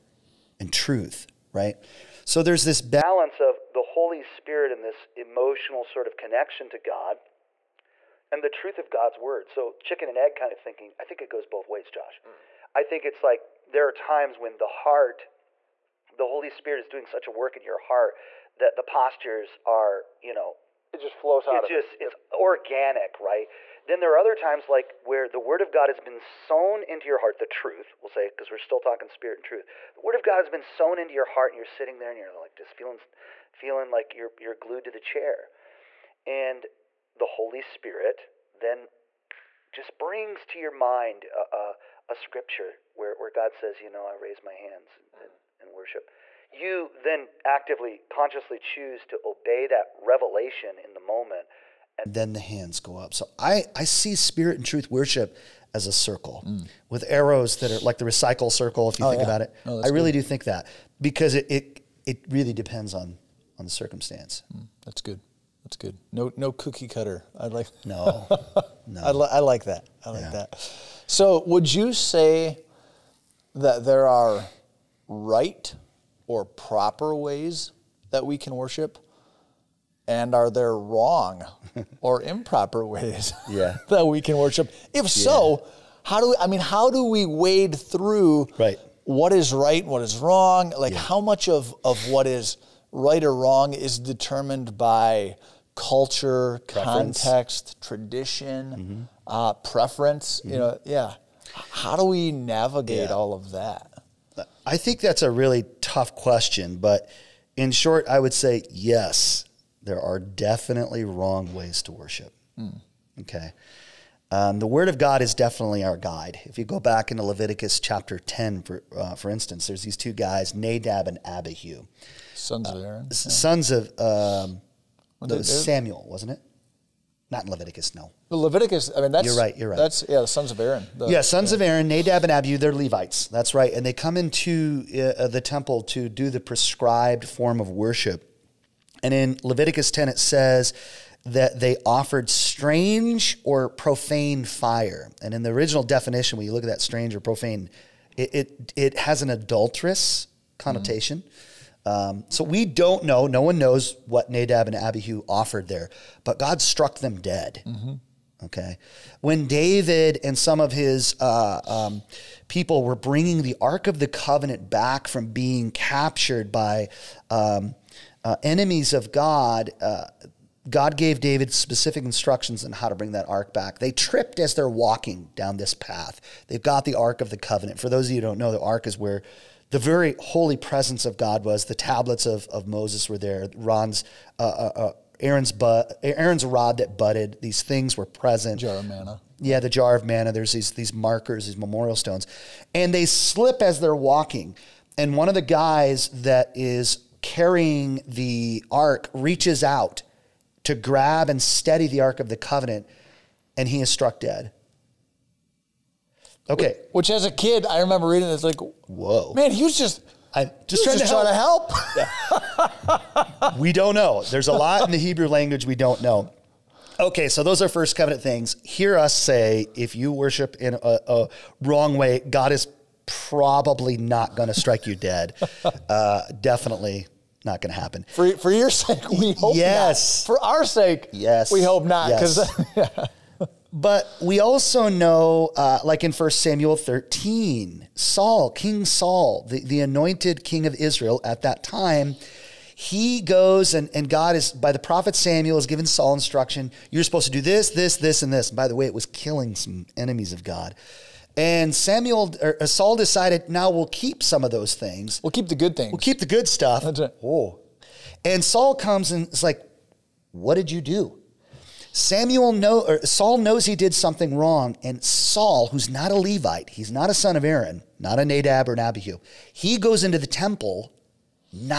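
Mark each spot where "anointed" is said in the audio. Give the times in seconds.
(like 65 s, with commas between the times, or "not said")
239 s.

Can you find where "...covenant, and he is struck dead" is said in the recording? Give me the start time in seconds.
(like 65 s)
202 s.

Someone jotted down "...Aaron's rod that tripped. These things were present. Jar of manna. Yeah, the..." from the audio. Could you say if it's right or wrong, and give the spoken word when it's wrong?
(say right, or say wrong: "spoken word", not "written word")
wrong: "budded", not "tripped".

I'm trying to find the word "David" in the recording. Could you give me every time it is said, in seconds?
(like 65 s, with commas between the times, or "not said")
159 s, 171 s.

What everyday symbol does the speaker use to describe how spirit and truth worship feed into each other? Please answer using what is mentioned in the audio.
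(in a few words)
recycle circle.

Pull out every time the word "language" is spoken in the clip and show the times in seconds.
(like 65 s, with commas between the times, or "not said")
215 s.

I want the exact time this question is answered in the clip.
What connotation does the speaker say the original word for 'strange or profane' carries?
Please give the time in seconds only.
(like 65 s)
149 s.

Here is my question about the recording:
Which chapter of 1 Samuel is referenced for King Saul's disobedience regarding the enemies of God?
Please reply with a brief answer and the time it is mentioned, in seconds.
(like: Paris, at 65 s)
13, at 236 s.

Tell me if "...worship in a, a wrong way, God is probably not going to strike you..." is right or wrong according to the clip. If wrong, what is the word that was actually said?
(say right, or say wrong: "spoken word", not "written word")
right.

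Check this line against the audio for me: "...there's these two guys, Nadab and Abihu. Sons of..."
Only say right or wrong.
right.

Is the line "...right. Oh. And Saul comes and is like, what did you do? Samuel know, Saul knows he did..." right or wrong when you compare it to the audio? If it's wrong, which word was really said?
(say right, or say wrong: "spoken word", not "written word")
right.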